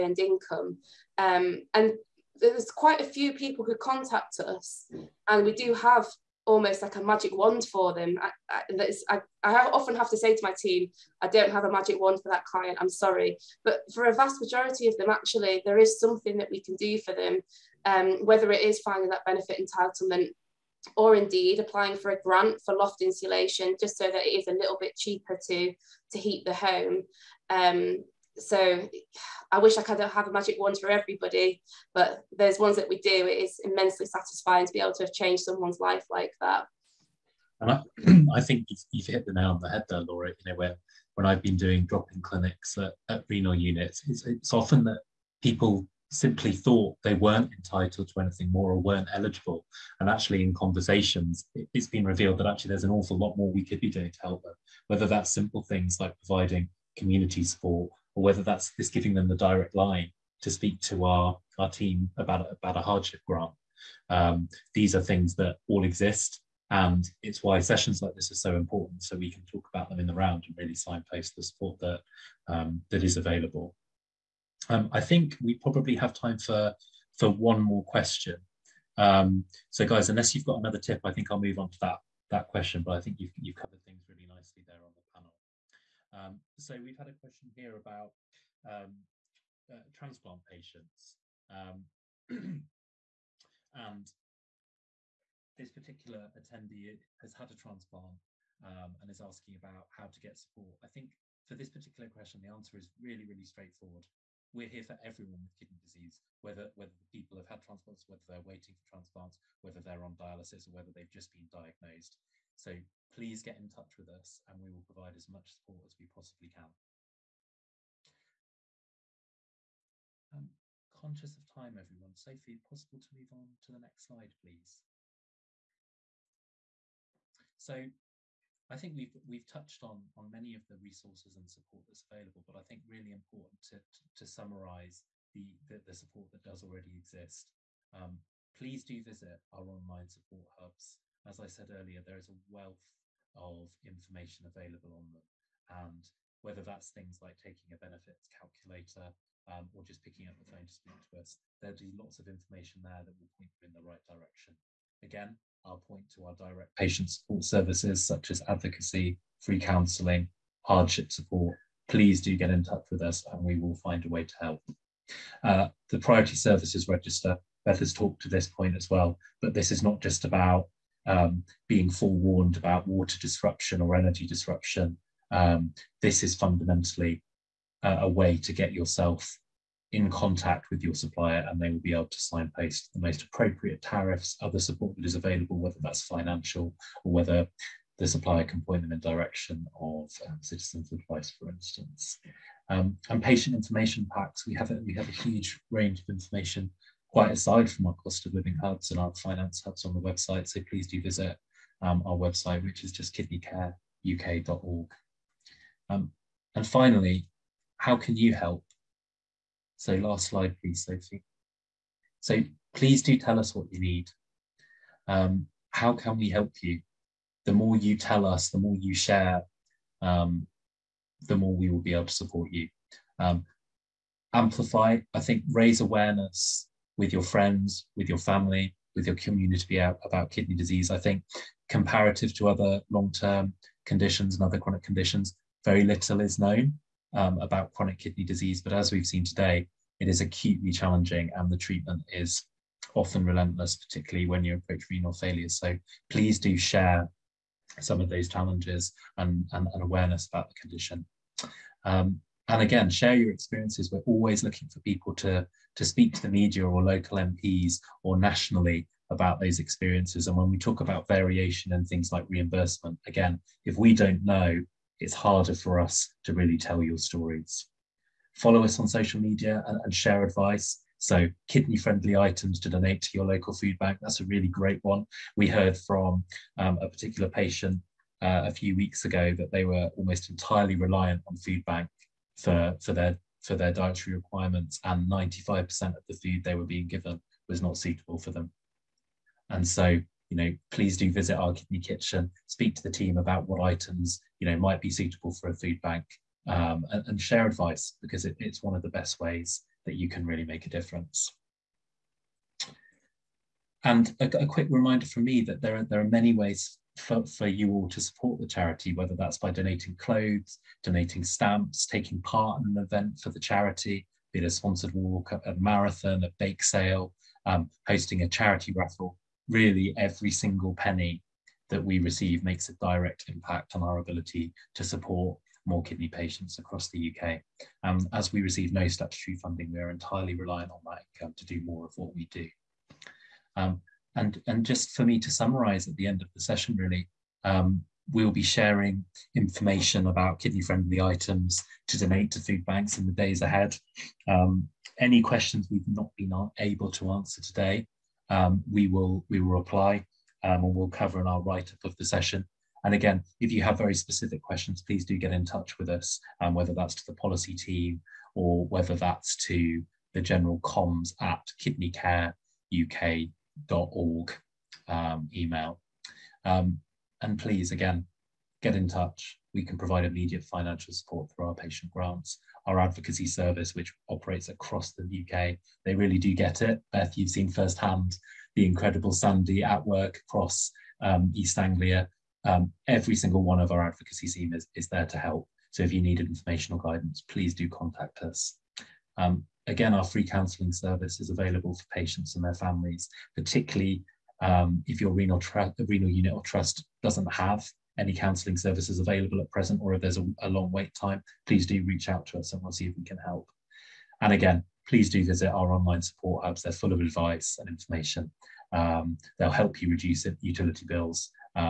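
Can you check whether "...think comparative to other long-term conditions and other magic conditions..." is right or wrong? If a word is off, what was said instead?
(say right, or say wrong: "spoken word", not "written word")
wrong: "chronic", not "magic".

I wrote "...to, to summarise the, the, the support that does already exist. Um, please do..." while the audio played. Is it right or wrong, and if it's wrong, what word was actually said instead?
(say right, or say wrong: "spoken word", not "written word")
right.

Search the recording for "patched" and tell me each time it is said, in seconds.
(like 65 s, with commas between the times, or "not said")
not said.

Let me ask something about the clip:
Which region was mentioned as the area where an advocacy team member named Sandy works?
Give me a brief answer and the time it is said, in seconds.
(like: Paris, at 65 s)
East Anglia, at 381 s.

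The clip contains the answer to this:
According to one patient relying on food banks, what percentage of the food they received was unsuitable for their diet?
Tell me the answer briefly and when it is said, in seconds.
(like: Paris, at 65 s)
95%, at 285 s.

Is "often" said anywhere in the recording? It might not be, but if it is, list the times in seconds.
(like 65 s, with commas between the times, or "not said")
9 s, 44 s, 242 s.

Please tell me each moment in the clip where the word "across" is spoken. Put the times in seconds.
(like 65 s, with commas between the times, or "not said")
326 s, 374 s, 380 s.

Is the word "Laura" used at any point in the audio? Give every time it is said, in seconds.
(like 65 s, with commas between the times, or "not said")
40 s.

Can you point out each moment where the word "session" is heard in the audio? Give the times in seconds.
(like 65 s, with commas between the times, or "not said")
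67 s, 336 s, 352 s.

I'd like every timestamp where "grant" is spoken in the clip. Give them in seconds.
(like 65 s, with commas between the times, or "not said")
22 s, 63 s, 371 s.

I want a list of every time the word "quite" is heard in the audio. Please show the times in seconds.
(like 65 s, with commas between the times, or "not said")
2 s, 197 s.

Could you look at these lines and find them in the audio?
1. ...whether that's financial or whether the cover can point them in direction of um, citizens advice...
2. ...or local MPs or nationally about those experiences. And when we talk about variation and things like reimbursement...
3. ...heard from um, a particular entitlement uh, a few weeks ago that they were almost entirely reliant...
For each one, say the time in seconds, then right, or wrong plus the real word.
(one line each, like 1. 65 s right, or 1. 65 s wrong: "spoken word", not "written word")
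1. 185 s wrong: "supplier", not "cover"
2. 256 s right
3. 275 s wrong: "patient", not "entitlement".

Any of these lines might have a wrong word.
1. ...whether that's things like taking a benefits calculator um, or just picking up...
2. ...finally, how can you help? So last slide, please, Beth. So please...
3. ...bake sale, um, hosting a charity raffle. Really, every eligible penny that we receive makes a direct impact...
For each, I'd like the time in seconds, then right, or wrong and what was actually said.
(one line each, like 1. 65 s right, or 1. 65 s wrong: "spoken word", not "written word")
1. 146 s right
2. 206 s wrong: "Sophie", not "Beth"
3. 316 s wrong: "single", not "eligible".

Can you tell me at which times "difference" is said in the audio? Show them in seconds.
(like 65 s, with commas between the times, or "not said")
300 s.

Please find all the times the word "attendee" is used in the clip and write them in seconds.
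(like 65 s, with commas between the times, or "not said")
96 s.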